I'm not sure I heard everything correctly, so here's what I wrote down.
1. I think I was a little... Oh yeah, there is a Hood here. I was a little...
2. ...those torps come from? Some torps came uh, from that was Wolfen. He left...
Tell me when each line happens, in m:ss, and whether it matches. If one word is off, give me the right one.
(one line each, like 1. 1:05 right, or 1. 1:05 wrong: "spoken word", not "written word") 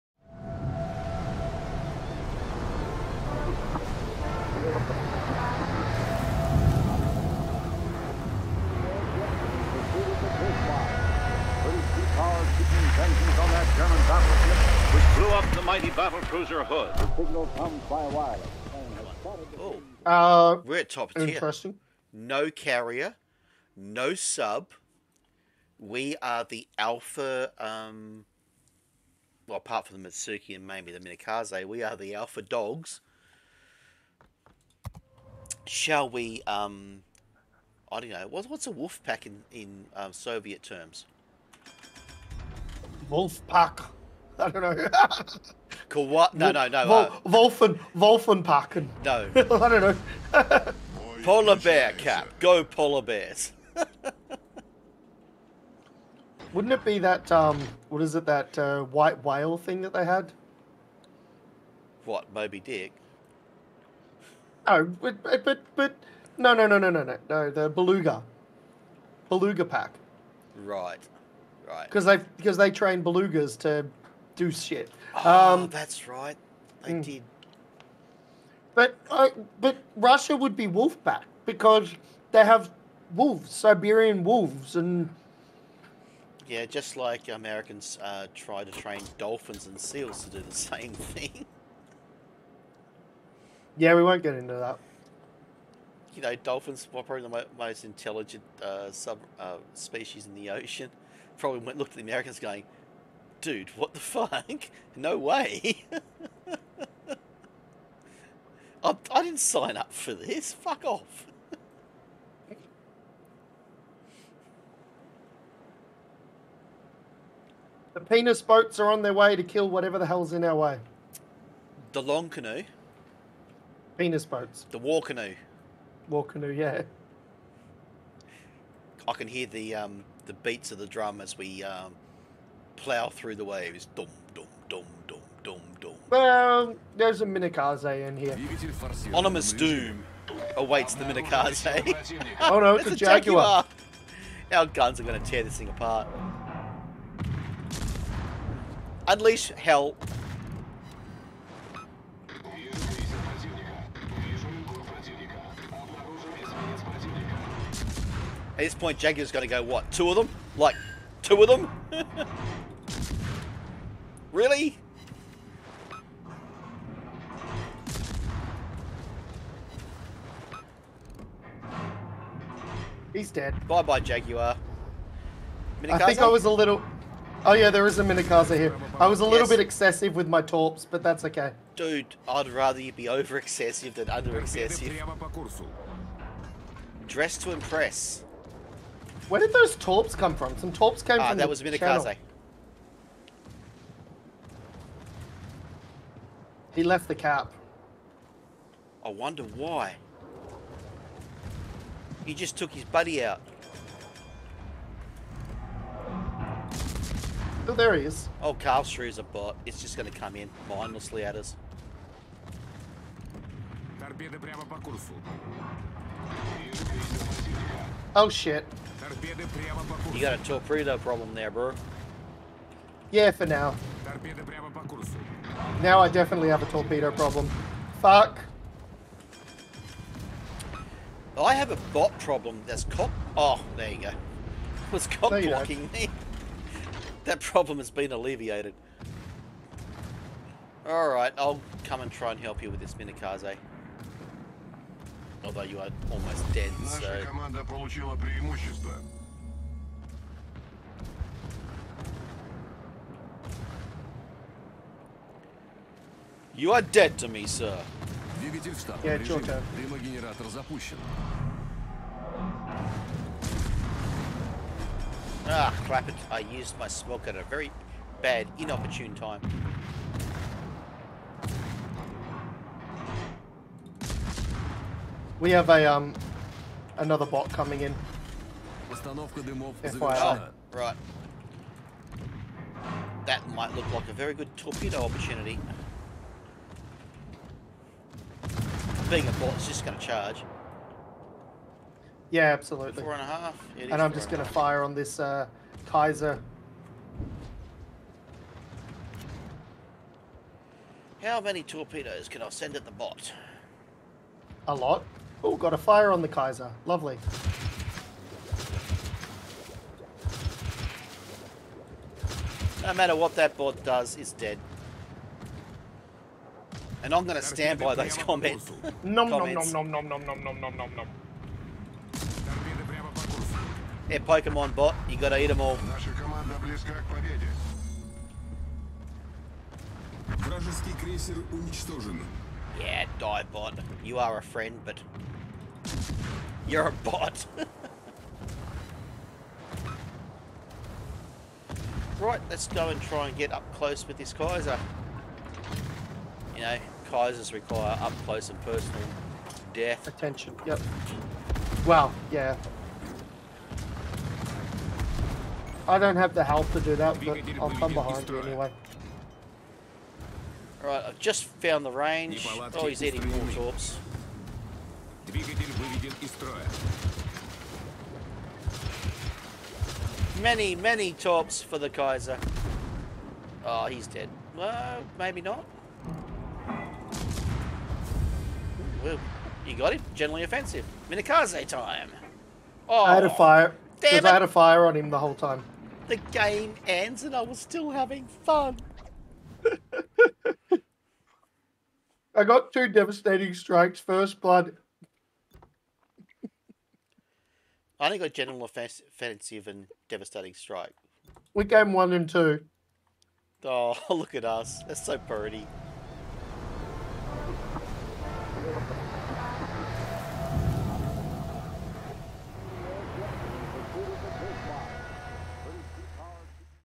1. 2:55 wrong: "Minekaze", not "Hood"
2. 3:09 wrong: "Minekaze", not "Wolfen".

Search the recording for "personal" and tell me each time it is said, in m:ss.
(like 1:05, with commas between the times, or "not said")
5:48.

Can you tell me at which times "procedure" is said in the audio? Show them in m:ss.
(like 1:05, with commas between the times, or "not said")
not said.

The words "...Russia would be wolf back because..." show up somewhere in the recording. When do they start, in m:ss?
1:19.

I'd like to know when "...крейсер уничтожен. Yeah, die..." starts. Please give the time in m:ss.
5:31.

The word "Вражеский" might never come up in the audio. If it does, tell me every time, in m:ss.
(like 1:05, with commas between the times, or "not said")
5:30.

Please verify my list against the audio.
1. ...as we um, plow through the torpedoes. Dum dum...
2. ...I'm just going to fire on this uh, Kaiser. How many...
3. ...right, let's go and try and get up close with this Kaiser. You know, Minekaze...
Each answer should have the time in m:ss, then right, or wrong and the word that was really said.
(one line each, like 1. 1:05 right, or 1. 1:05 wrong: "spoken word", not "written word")
1. 2:11 wrong: "waves", not "torpedoes"
2. 4:54 right
3. 5:42 wrong: "Kaisers", not "Minekaze".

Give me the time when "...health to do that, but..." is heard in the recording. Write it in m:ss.
5:56.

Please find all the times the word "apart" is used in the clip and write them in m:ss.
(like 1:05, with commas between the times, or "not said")
0:29, 2:25.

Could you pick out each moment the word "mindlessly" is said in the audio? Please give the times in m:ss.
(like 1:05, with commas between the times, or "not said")
3:30.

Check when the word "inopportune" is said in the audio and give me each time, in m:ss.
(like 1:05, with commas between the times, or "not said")
4:28.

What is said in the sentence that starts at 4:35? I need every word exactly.
We have a um another bot coming in.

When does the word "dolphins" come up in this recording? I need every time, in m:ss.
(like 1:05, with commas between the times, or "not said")
1:29, 1:36.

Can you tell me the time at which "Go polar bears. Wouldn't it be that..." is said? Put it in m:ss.
0:52.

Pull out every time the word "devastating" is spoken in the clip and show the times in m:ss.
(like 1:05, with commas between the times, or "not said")
6:32, 6:40.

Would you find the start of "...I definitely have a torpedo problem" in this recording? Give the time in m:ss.
3:45.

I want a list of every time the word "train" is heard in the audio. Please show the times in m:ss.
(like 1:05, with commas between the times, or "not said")
1:12, 1:28.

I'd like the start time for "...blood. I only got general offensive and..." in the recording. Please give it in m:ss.
6:34.